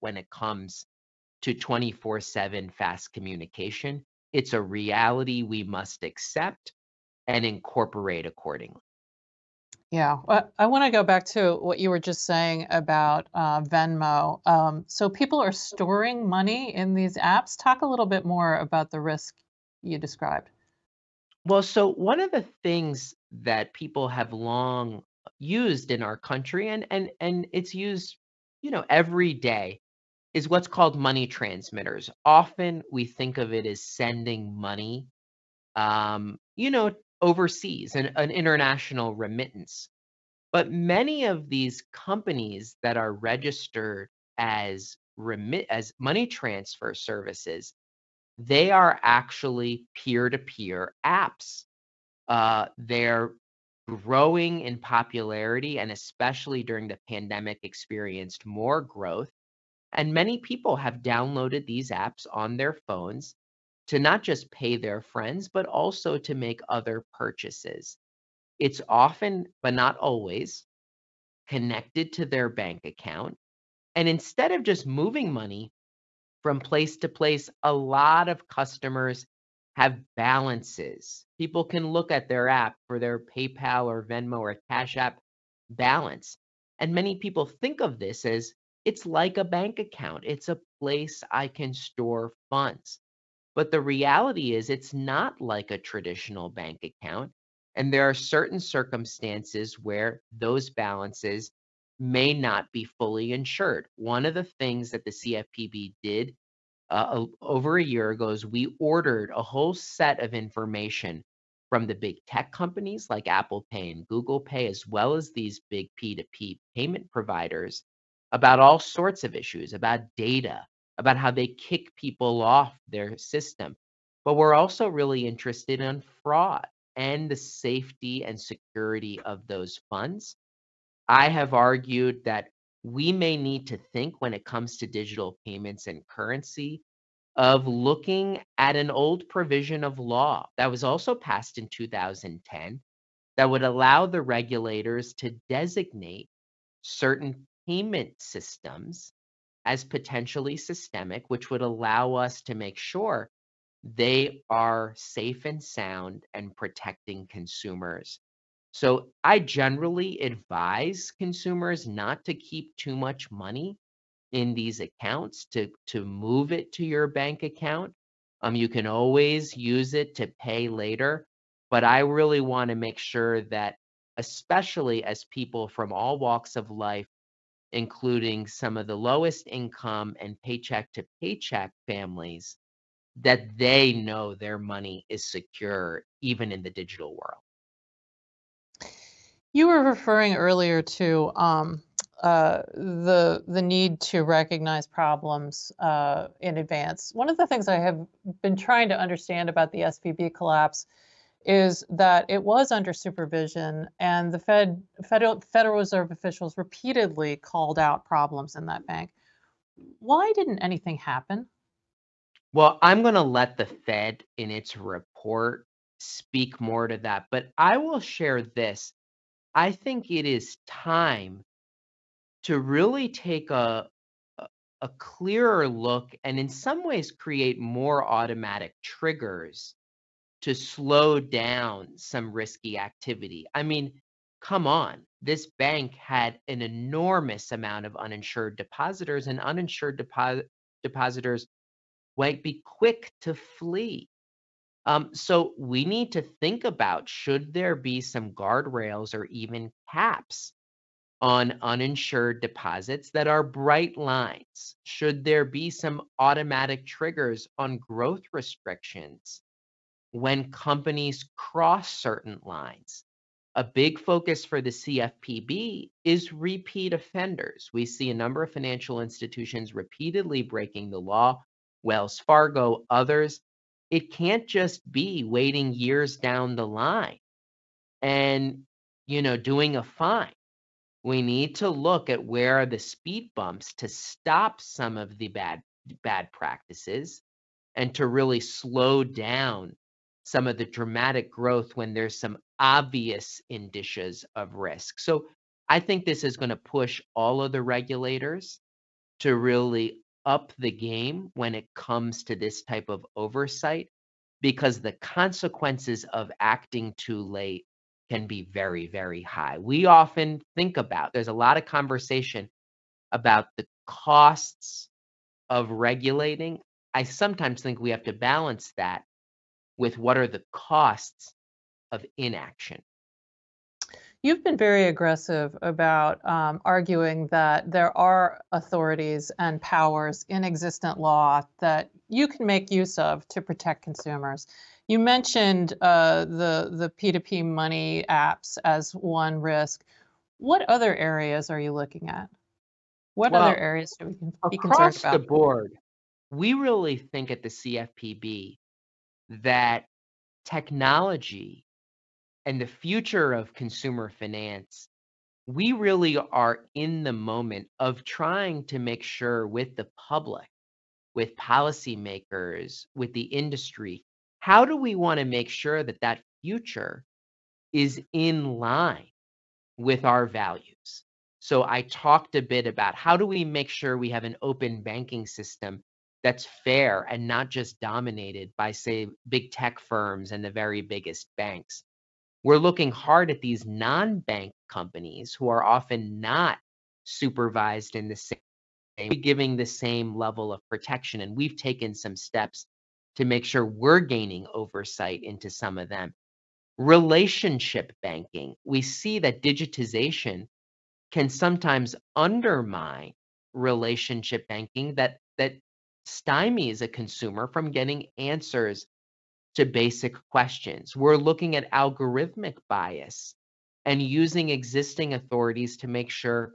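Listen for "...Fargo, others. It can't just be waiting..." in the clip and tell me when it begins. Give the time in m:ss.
4:32.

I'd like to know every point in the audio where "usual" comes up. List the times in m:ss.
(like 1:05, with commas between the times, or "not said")
not said.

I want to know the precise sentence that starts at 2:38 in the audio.
So I generally advise consumers not to keep too much money in these accounts to to move it to your bank account.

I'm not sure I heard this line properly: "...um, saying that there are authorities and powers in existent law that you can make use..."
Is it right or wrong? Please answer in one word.
wrong.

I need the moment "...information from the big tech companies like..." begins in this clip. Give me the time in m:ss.
1:50.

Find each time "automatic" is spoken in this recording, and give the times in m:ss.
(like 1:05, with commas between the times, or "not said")
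3:48, 4:16.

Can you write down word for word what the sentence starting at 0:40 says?
But many of these companies that are registered as remit as money transfer services, they are actually peer-to-peer apps.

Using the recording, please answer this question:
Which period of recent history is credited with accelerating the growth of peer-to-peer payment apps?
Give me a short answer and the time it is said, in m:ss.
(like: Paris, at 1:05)
The pandemic, at 0:56.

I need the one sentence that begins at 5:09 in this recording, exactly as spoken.
We often think about, there's a lot of conversation about the costs of regulating.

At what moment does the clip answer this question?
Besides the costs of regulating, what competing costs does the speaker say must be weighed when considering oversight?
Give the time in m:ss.
5:20.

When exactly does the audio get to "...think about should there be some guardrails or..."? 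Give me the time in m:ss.
4:06.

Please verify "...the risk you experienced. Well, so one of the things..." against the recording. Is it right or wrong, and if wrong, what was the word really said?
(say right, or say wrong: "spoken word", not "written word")
wrong: "described", not "experienced".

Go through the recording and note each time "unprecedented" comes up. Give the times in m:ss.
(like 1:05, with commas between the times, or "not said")
not said.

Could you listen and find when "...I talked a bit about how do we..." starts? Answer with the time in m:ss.
6:11.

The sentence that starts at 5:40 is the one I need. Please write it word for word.
What other areas are you looking at?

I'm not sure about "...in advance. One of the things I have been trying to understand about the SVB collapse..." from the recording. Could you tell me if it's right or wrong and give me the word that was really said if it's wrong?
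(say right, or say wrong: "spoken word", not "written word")
right.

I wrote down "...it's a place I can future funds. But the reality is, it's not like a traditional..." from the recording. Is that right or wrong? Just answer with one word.
wrong.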